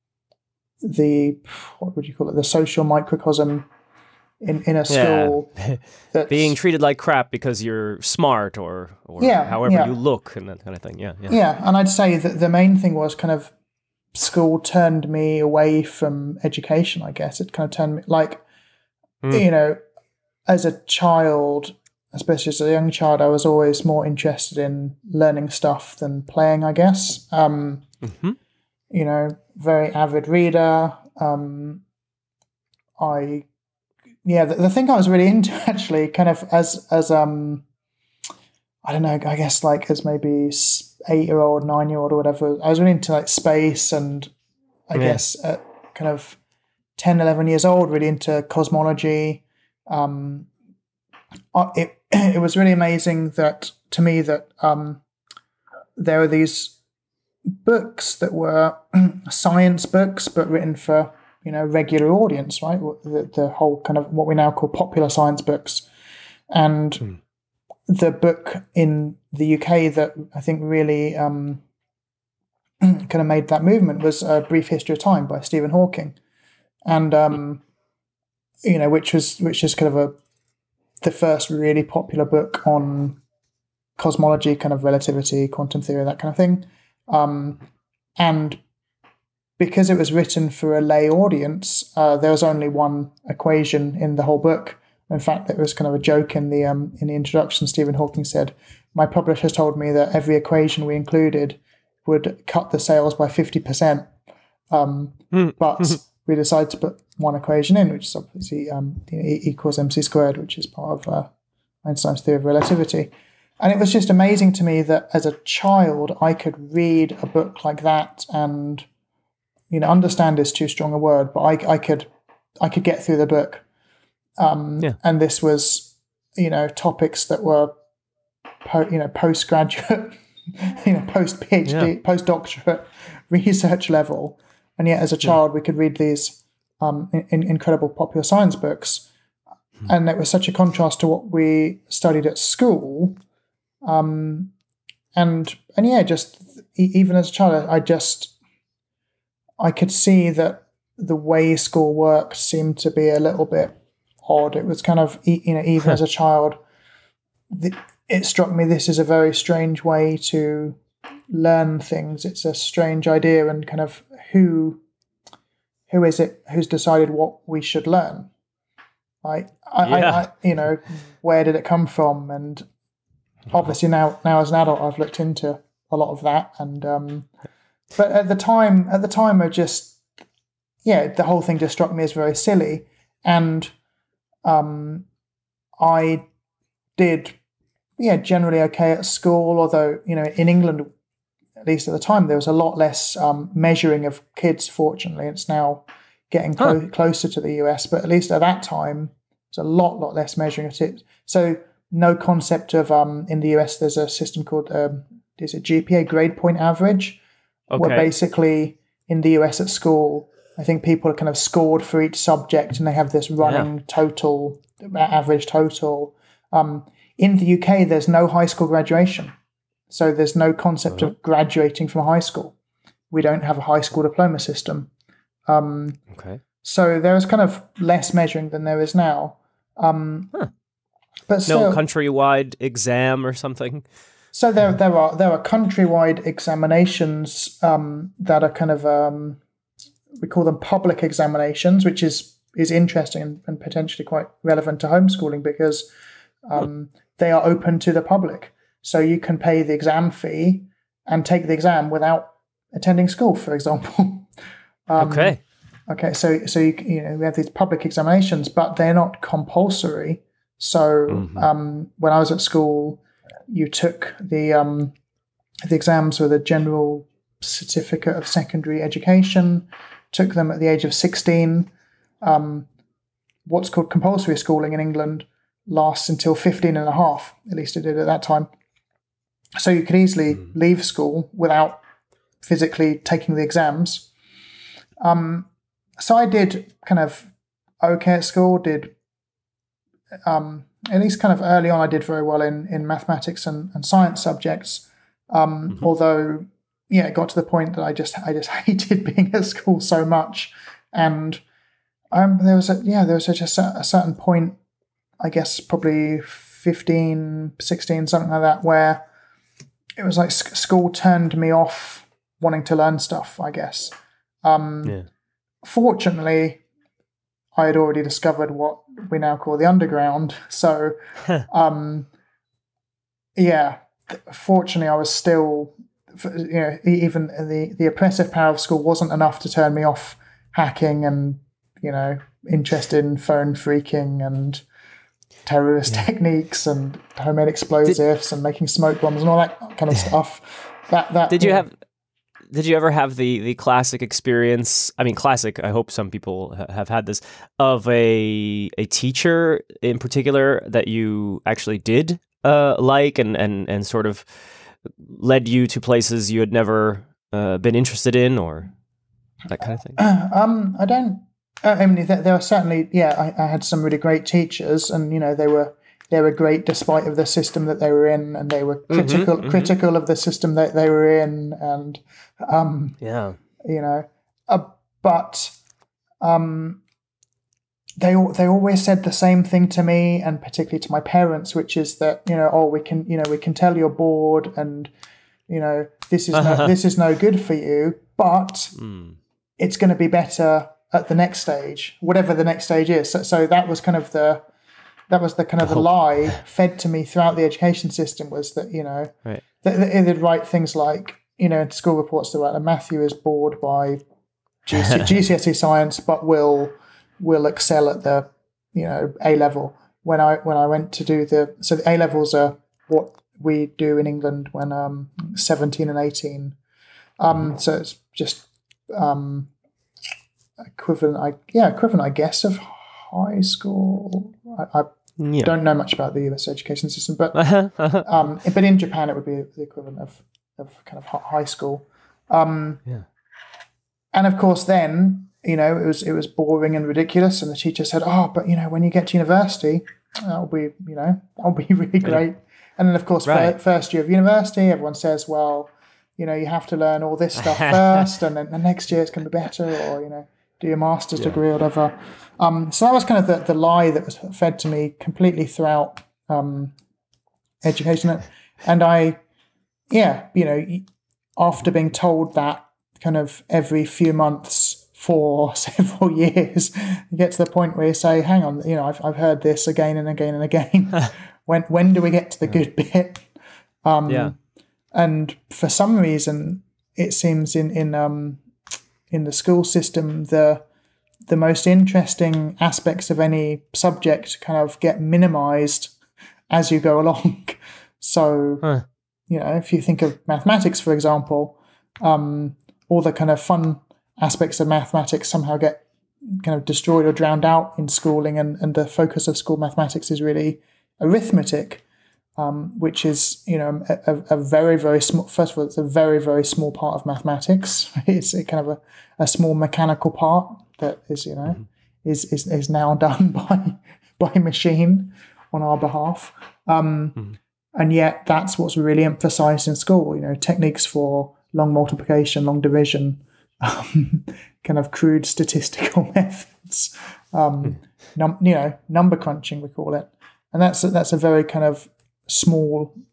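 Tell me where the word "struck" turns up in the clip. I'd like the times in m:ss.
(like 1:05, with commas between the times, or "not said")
2:38, 3:01.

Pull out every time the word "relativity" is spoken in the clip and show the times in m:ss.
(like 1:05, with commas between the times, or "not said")
1:24, 1:52.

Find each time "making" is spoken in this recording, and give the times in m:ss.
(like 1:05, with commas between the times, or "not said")
5:38.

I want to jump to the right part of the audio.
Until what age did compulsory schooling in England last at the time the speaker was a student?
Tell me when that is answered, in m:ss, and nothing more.
4:36.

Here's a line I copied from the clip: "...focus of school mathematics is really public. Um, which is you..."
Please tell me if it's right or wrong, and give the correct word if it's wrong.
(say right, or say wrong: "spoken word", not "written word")
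wrong: "arithmetic", not "public".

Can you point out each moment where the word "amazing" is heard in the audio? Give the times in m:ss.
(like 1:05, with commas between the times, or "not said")
0:52, 1:54.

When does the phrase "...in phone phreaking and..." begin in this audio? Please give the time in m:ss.
5:32.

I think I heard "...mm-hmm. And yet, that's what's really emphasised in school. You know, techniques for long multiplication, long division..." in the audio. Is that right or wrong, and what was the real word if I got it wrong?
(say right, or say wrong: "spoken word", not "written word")
right.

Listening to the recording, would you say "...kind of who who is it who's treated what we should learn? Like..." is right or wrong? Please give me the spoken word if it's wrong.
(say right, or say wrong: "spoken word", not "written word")
wrong: "decided", not "treated".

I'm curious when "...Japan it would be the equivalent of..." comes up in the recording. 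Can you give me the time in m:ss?
7:08.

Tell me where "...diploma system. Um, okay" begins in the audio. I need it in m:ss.
3:44.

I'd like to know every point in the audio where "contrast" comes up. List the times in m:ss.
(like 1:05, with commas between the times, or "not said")
2:20.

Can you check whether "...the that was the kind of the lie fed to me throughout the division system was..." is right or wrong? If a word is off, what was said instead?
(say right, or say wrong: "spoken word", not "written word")
wrong: "education", not "division".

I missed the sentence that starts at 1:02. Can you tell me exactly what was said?
The, the whole kind of what we now call popular science books, and hmm.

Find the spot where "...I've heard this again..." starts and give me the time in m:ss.
7:49.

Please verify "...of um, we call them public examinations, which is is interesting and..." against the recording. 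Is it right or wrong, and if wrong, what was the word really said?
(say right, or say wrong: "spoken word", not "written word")
right.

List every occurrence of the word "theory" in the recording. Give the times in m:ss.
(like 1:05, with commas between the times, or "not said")
1:25, 1:52.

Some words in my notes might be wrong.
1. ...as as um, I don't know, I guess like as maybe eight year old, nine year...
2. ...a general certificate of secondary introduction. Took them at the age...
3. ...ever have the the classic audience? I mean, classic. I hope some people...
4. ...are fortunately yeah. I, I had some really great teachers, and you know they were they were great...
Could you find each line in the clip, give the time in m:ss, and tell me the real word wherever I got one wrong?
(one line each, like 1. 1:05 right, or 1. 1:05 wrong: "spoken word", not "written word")
1. 0:36 right
2. 4:26 wrong: "education", not "introduction"
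3. 5:42 wrong: "experience", not "audience"
4. 6:02 wrong: "certainly", not "fortunately".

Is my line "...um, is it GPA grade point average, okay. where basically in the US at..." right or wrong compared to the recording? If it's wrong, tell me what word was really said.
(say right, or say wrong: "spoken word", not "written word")
right.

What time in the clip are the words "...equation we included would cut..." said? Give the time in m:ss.
1:40.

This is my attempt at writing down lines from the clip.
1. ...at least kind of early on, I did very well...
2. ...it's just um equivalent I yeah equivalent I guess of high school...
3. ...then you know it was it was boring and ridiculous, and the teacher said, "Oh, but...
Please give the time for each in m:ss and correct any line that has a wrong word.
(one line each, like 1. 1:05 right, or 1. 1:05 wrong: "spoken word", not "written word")
1. 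4:50 right
2. 6:57 right
3. 7:14 right.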